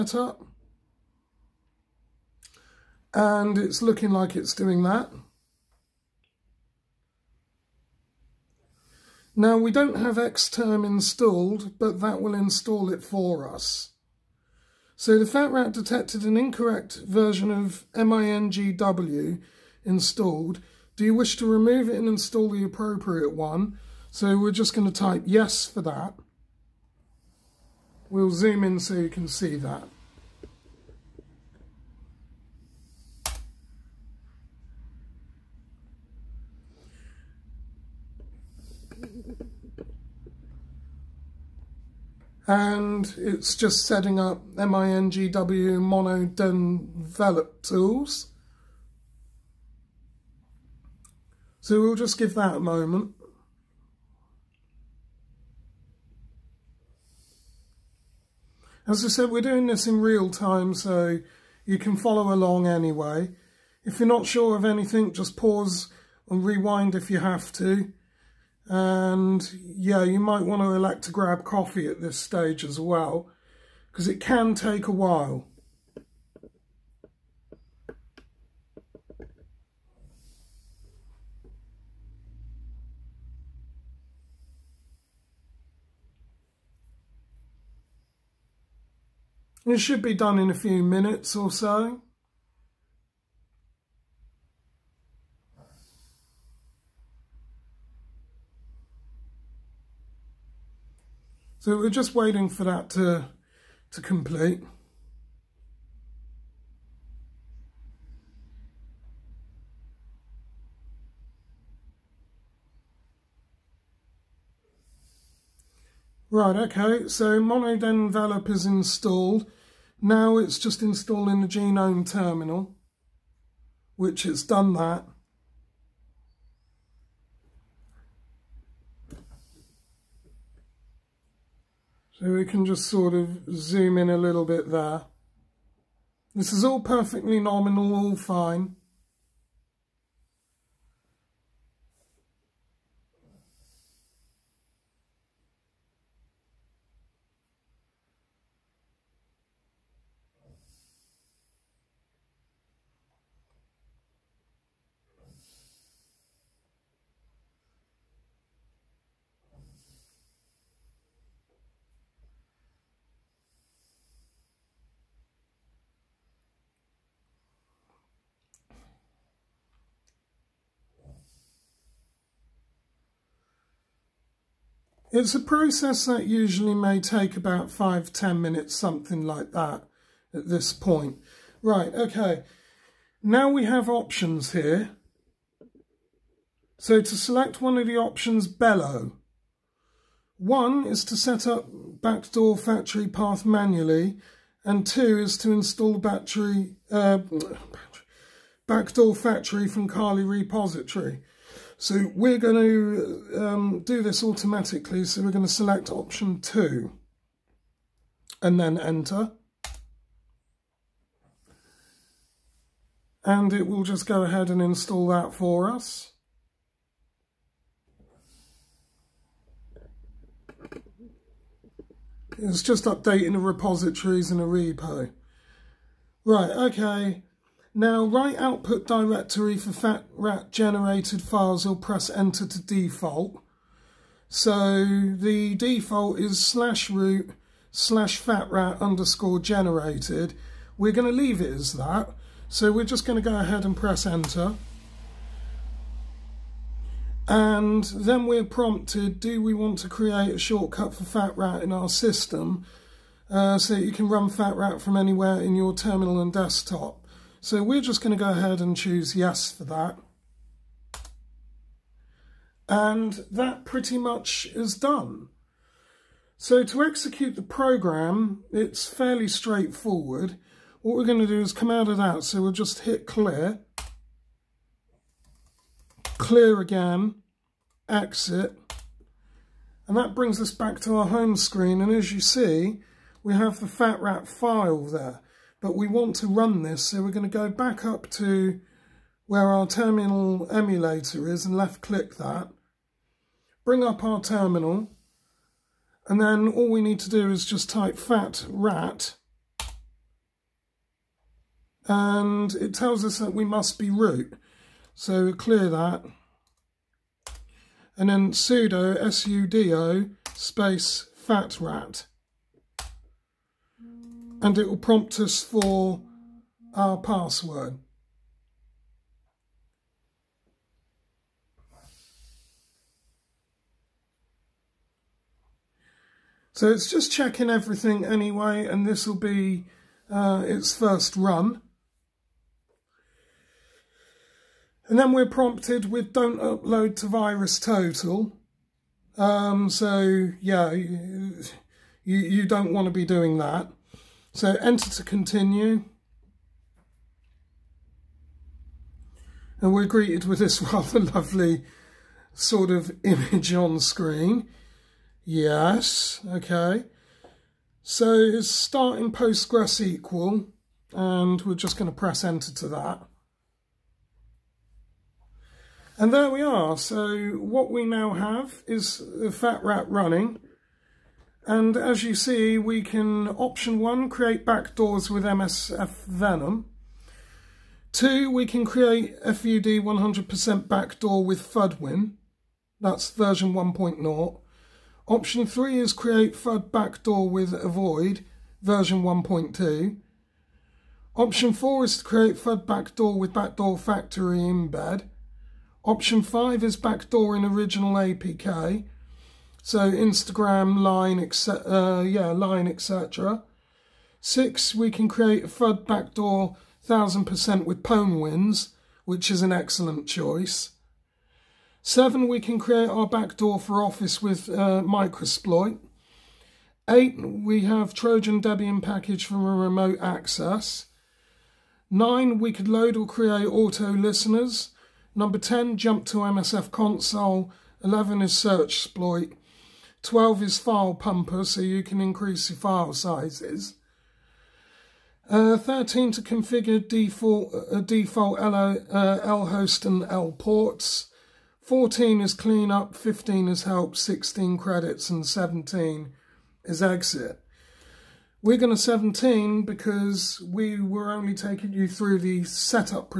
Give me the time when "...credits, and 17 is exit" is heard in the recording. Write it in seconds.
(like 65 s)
444 s.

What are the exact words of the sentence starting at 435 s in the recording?
Uh, 13 to configure default, uh, default l uh, L host and L ports.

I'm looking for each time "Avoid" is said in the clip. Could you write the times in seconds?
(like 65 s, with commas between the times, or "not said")
387 s.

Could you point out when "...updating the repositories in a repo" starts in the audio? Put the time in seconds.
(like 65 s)
222 s.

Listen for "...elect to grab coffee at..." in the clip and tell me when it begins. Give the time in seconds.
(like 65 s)
70 s.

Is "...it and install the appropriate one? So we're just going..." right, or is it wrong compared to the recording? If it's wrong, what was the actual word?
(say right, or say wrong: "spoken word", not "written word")
right.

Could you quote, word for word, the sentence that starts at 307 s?
And then sudo, S-U-D-O, space fat rat and it will prompt us for our password.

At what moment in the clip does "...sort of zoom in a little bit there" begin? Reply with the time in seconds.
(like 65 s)
132 s.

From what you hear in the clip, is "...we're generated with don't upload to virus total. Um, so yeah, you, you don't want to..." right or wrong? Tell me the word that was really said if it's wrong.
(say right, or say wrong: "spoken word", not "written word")
wrong: "prompted", not "generated".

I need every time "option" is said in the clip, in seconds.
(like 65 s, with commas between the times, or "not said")
183 s, 187 s, 205 s, 373 s, 385 s, 391 s, 395 s.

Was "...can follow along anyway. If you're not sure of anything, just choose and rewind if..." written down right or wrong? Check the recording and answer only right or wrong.
wrong.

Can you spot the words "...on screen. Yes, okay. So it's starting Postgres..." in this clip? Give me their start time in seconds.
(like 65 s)
353 s.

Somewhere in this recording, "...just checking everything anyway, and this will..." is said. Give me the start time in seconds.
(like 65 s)
326 s.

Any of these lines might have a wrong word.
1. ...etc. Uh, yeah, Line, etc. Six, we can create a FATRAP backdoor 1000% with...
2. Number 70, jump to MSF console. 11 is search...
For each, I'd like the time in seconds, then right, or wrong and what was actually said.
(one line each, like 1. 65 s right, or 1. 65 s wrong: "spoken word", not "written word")
1. 401 s wrong: "FUD", not "FATRAP"
2. 425 s wrong: "10", not "70".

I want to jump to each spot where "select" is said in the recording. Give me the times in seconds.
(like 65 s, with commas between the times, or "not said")
187 s, 205 s.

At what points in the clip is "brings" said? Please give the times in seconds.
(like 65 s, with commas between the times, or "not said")
280 s, 293 s.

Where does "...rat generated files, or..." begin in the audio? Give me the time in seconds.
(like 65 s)
230 s.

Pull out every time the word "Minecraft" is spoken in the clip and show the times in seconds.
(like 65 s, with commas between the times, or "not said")
not said.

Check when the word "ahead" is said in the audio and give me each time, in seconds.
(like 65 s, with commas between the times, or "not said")
214 s, 243 s, 258 s.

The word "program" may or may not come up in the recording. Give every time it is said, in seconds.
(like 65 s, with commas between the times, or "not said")
267 s.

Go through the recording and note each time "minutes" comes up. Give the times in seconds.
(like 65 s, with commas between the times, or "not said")
90 s, 178 s.